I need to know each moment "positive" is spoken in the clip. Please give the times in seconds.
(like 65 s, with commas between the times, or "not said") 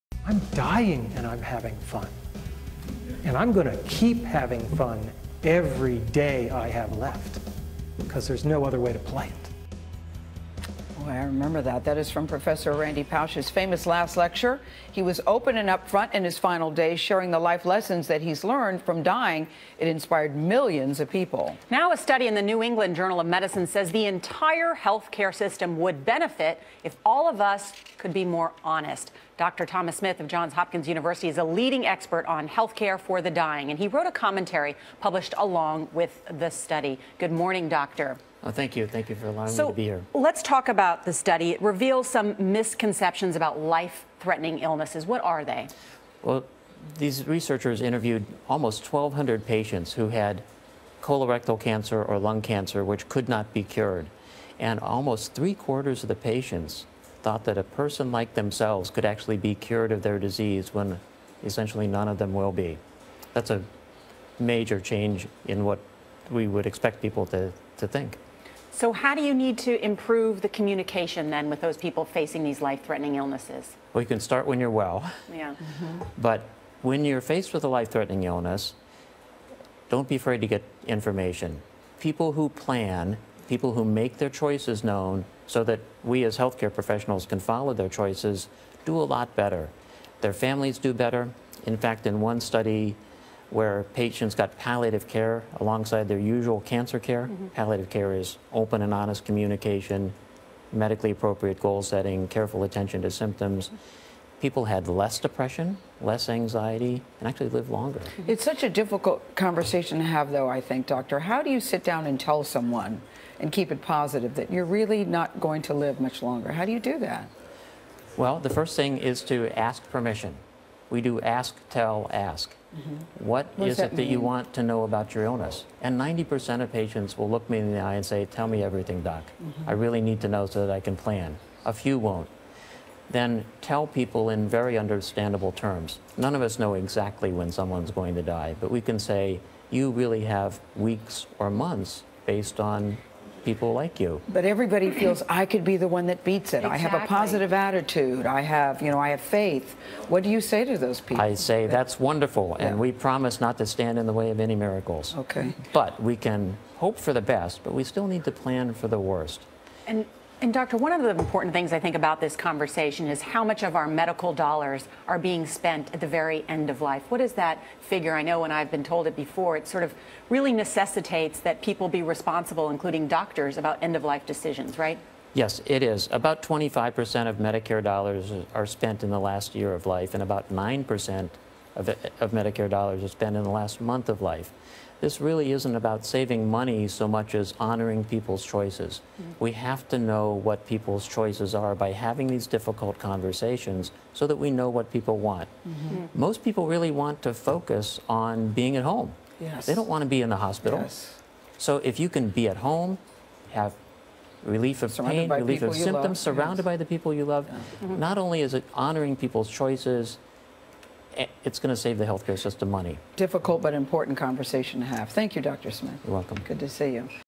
113 s, 147 s.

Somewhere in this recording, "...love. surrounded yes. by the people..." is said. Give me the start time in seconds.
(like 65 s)
206 s.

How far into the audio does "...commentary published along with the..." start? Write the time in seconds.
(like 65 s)
34 s.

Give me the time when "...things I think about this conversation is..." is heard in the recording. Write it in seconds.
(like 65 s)
161 s.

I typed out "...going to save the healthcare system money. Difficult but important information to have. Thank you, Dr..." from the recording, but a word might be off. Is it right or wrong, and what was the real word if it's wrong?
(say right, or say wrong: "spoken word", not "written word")
wrong: "conversation", not "information".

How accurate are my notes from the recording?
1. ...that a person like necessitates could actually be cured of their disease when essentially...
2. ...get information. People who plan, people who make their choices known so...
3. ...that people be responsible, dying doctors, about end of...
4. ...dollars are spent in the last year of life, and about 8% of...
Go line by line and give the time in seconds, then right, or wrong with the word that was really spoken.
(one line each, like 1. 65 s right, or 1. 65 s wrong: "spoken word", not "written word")
1. 57 s wrong: "themselves", not "necessitates"
2. 80 s right
3. 171 s wrong: "including", not "dying"
4. 177 s wrong: "9", not "8".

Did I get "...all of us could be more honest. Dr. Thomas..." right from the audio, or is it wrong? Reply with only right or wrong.
right.